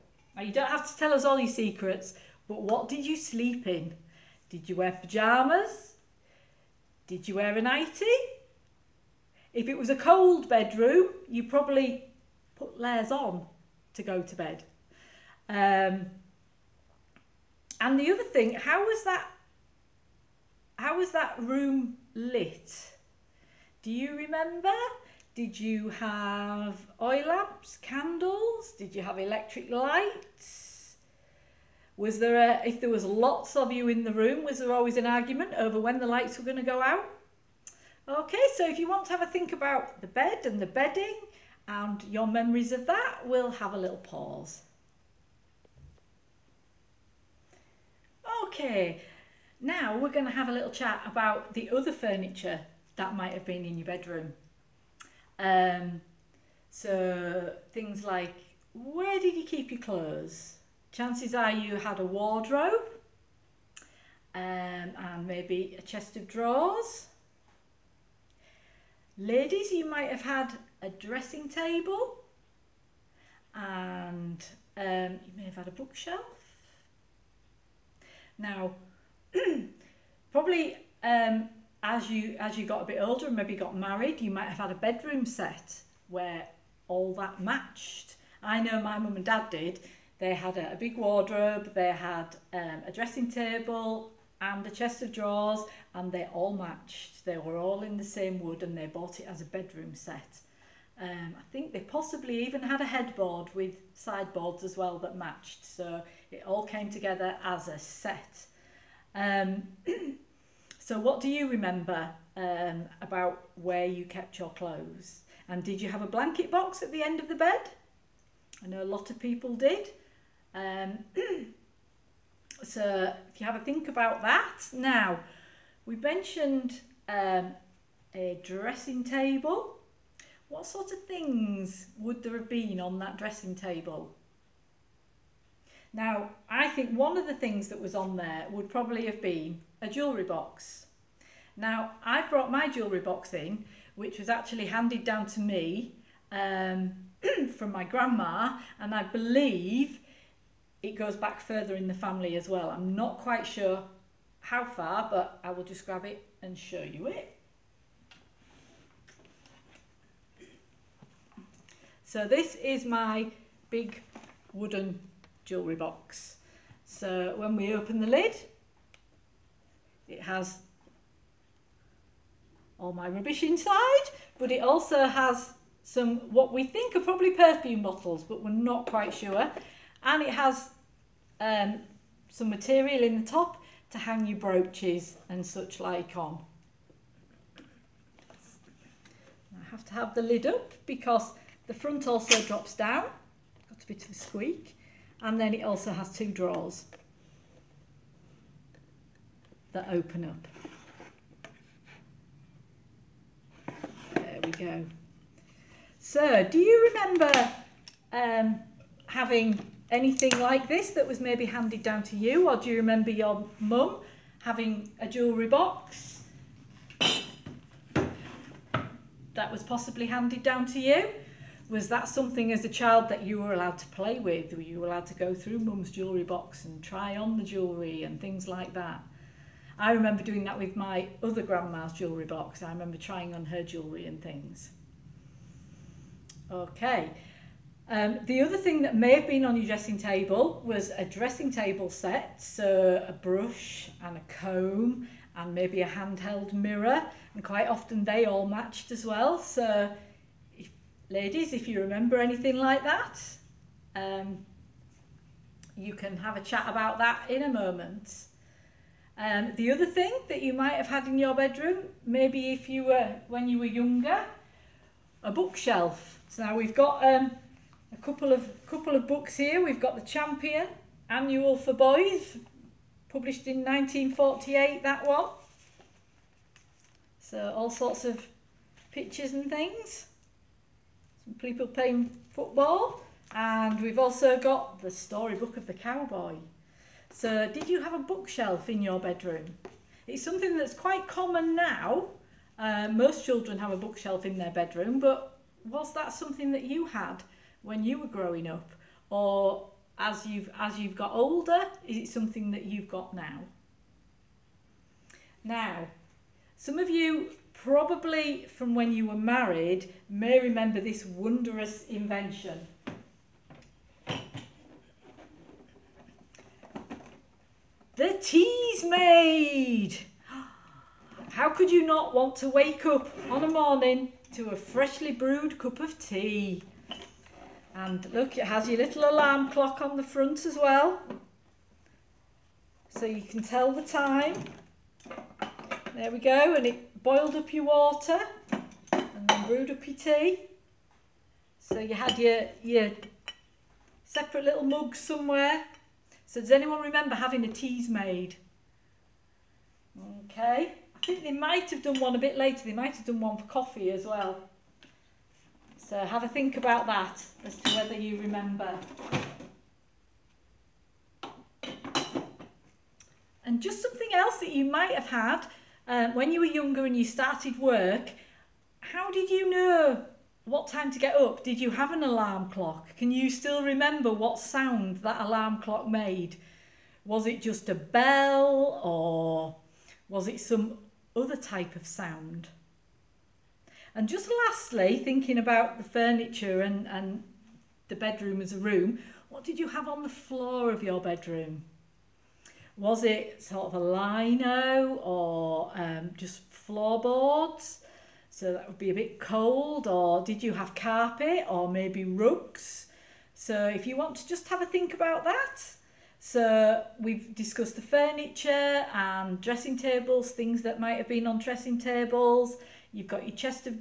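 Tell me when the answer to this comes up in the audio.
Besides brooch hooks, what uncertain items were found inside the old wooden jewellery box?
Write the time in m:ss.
2:57.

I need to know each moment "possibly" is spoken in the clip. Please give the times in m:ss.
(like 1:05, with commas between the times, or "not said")
1:41, 3:39.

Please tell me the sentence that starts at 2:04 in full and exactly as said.
Now, we mentioned um, a dressing table.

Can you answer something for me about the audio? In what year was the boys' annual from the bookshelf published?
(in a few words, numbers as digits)
1948.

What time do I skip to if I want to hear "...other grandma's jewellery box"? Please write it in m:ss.
3:51.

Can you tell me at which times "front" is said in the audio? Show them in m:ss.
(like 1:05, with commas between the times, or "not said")
3:11, 5:30.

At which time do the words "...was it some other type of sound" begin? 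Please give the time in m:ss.
6:20.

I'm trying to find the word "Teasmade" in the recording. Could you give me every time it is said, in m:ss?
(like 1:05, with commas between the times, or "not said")
5:18, 5:47.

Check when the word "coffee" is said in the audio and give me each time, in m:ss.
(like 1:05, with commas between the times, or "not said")
5:53.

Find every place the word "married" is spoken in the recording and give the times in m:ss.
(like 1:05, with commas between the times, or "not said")
1:23, 5:09.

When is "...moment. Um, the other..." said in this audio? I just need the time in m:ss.
4:17.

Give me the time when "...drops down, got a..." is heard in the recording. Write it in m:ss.
3:12.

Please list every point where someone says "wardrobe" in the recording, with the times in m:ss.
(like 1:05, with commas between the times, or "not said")
1:02, 1:30.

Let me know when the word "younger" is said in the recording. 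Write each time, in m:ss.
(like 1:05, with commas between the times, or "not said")
4:23, 6:06.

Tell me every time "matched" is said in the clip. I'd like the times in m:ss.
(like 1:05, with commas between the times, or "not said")
1:27, 1:36, 1:45, 4:08.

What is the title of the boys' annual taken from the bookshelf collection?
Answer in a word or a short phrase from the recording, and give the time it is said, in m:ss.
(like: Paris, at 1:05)
The Champion, at 4:29.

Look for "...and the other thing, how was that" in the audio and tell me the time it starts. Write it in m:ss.
0:17.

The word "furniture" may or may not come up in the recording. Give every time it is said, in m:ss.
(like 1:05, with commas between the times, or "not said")
0:51, 6:25, 6:47.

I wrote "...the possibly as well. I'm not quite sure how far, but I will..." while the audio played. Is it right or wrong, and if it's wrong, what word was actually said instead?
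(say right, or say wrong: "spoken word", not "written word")
wrong: "family", not "possibly".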